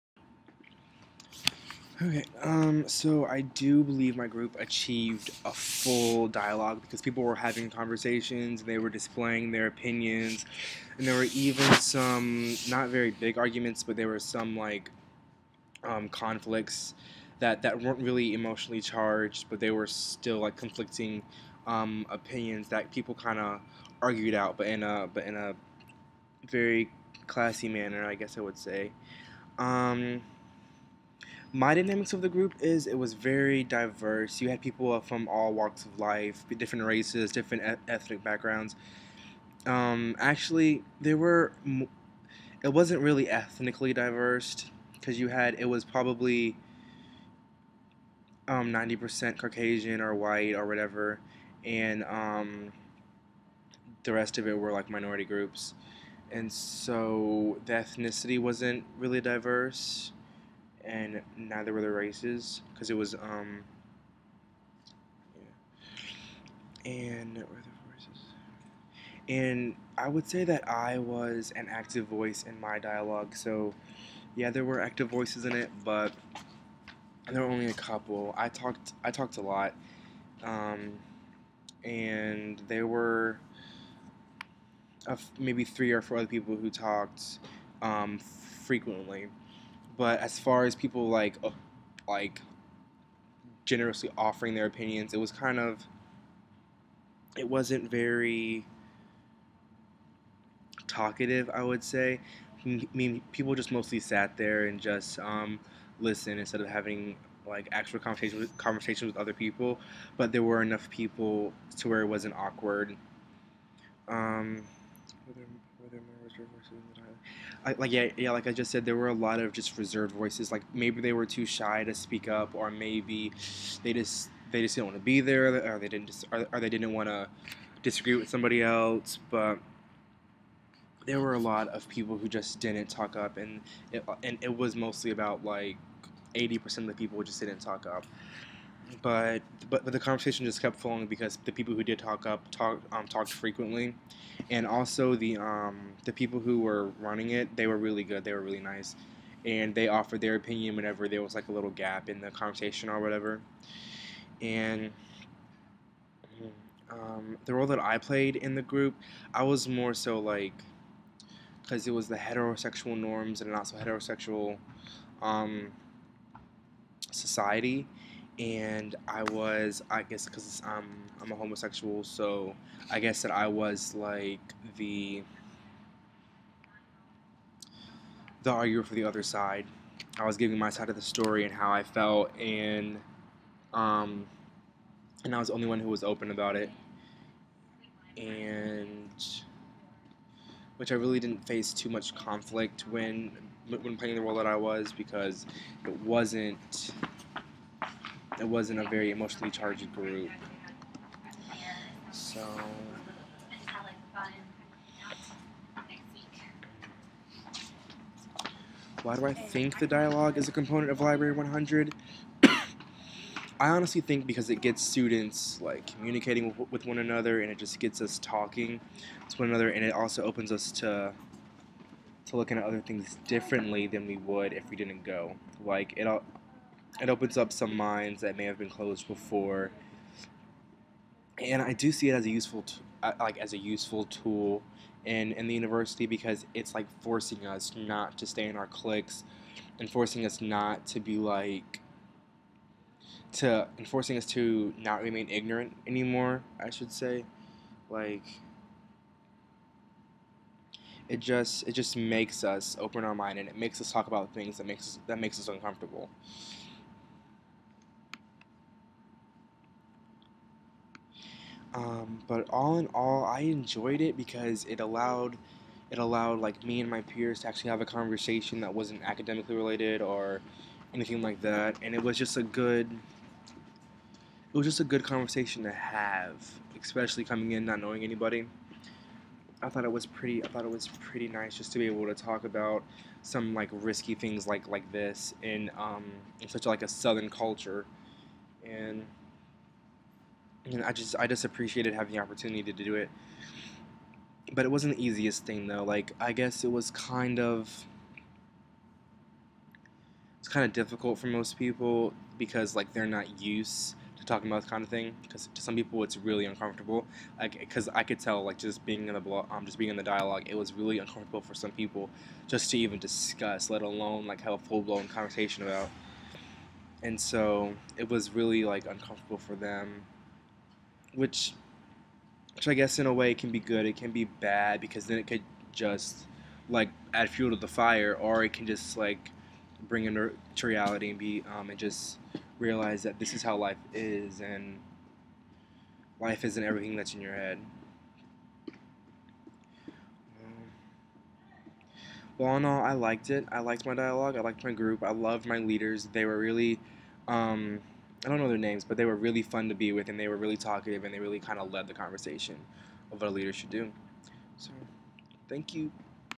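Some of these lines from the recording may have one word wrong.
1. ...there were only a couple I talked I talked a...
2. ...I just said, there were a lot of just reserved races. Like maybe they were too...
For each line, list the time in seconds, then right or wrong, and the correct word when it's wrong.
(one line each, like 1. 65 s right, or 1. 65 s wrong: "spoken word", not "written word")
1. 77 s right
2. 118 s wrong: "voices", not "races".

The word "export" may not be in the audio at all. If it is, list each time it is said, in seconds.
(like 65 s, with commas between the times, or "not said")
not said.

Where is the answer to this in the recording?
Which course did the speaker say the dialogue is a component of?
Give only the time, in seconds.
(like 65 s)
211 s.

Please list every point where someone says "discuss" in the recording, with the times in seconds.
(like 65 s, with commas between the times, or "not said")
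312 s.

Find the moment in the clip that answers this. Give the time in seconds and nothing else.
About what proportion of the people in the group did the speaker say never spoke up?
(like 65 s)
136 s.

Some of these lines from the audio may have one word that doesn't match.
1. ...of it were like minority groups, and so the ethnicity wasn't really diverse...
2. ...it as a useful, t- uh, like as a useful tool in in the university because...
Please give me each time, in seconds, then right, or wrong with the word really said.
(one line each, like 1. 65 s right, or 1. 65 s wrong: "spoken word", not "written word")
1. 54 s right
2. 232 s right.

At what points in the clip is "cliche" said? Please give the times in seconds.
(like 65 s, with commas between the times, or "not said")
not said.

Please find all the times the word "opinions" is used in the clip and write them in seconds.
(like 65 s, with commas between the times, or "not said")
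9 s, 22 s, 94 s, 150 s.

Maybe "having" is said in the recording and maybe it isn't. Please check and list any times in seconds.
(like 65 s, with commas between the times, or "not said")
7 s, 106 s, 291 s.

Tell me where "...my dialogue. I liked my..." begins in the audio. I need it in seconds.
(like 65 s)
343 s.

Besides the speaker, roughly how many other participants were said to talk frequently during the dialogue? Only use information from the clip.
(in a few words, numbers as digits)
3 or 4.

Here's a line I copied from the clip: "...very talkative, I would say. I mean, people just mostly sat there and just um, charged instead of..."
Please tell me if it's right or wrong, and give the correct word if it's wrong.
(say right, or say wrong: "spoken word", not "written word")
wrong: "listened", not "charged".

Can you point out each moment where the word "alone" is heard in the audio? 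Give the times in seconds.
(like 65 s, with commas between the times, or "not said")
313 s.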